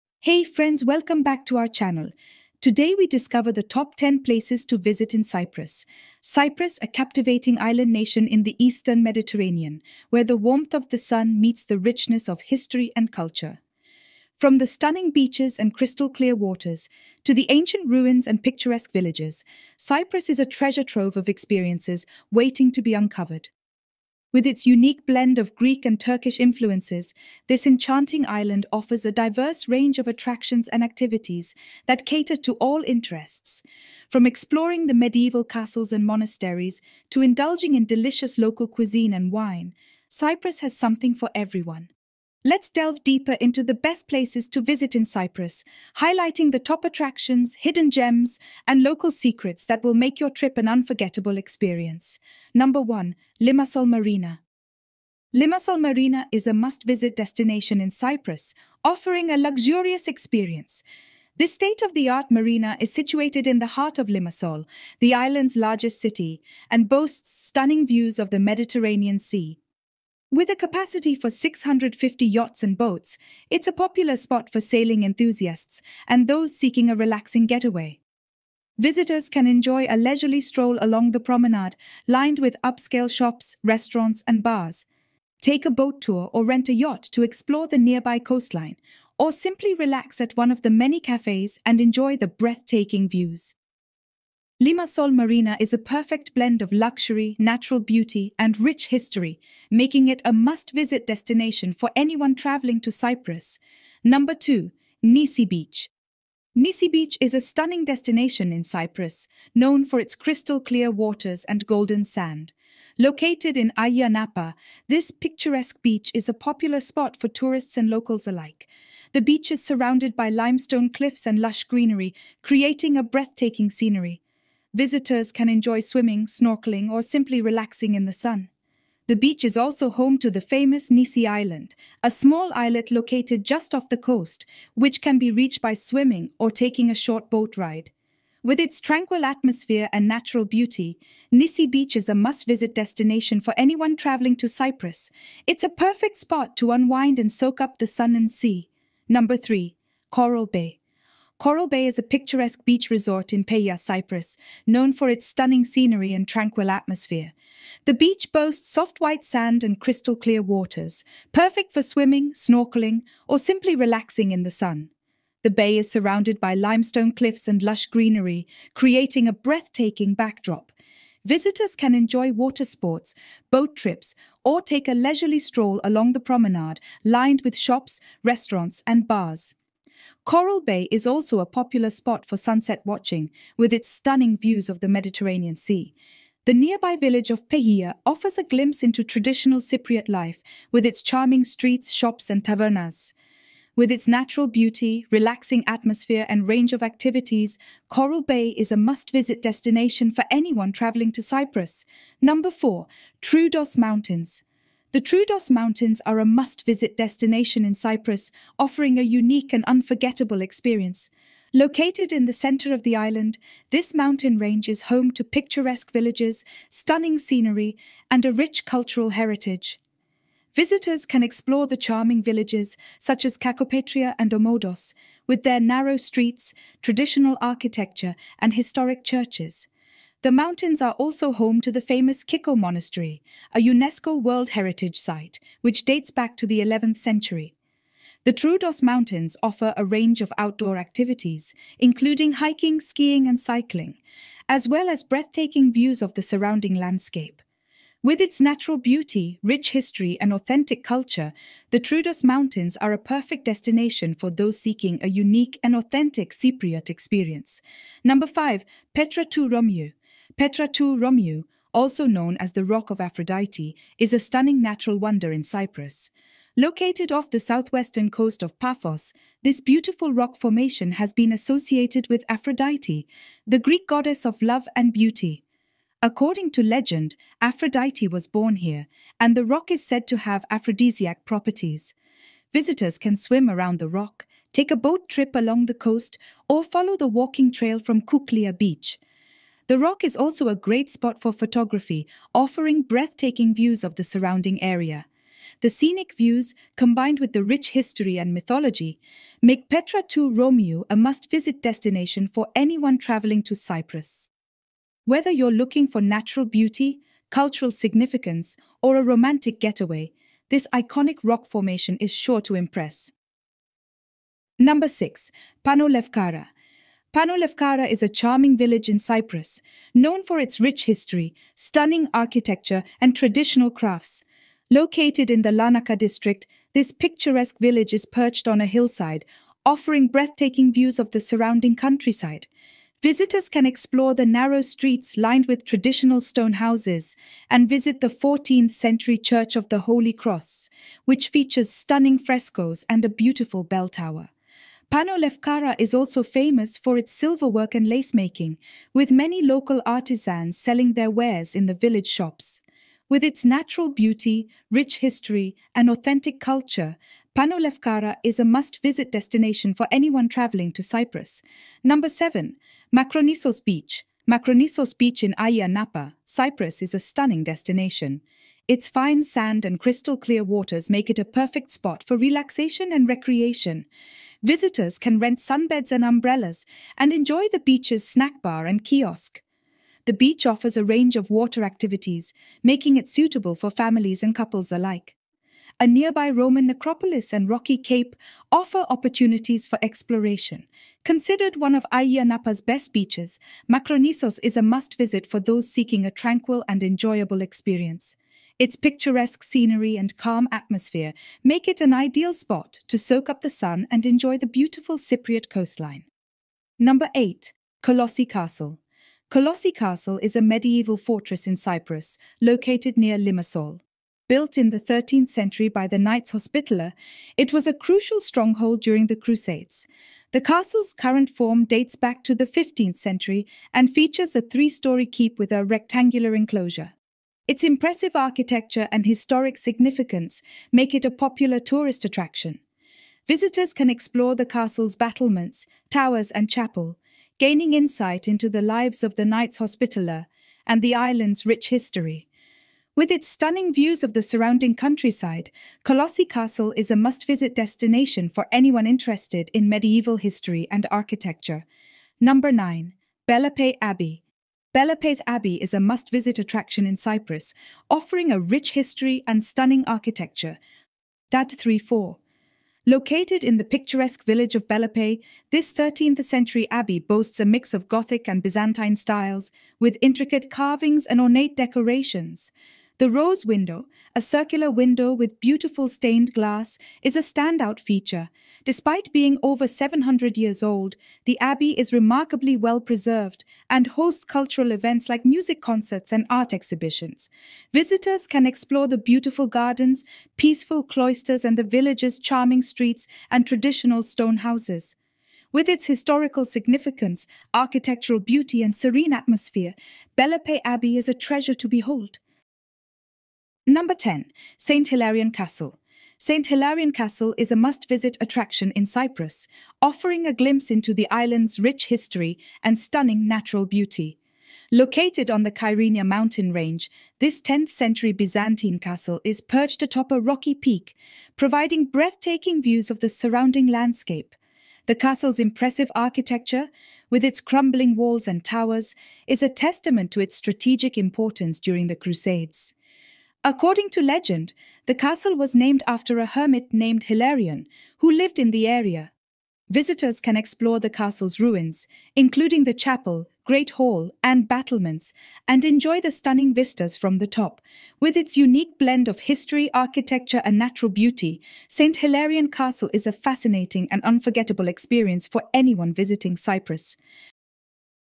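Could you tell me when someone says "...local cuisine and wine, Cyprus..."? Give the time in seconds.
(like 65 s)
38 s.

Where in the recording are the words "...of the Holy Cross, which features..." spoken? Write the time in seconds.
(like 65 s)
339 s.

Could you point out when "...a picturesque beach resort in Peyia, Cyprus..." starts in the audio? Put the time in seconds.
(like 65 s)
151 s.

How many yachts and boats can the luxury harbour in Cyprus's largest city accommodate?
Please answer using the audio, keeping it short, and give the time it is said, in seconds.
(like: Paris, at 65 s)
650, at 71 s.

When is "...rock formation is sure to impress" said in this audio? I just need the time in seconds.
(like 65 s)
311 s.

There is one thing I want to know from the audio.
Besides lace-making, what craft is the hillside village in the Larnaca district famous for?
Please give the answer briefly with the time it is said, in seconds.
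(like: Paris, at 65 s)
silverwork, at 347 s.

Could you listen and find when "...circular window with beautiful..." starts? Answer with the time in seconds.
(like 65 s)
474 s.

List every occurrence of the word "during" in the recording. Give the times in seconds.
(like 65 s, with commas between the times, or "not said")
418 s, 531 s.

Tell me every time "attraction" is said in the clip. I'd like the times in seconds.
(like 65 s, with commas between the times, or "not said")
30 s, 46 s, 432 s, 456 s, 508 s.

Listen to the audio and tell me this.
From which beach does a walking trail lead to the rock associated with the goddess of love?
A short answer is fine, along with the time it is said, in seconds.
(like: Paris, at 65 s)
Kuklia Beach, at 288 s.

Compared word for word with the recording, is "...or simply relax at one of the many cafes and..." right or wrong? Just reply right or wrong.
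right.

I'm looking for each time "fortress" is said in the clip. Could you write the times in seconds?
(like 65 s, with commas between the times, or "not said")
410 s.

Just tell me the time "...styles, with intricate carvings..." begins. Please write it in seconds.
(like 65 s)
468 s.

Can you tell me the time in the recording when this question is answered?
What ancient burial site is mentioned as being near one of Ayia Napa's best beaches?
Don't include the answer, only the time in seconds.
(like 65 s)
386 s.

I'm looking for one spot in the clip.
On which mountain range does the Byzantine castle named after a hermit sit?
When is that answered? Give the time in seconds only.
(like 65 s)
515 s.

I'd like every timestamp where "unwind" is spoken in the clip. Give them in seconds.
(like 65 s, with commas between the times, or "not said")
146 s.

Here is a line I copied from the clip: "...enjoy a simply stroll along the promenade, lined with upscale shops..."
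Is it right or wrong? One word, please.
wrong.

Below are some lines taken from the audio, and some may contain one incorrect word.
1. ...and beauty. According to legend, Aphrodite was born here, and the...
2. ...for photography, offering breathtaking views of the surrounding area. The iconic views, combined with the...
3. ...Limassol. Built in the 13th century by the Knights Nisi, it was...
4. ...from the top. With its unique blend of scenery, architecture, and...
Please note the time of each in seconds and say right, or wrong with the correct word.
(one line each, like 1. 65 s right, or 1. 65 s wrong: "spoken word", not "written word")
1. 274 s right
2. 291 s wrong: "scenic", not "iconic"
3. 413 s wrong: "Hospitaller", not "Nisi"
4. 546 s wrong: "history", not "scenery".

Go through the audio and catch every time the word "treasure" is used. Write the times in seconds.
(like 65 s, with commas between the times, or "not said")
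20 s, 501 s.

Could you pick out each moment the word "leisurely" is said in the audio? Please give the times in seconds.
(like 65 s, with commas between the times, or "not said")
79 s, 174 s.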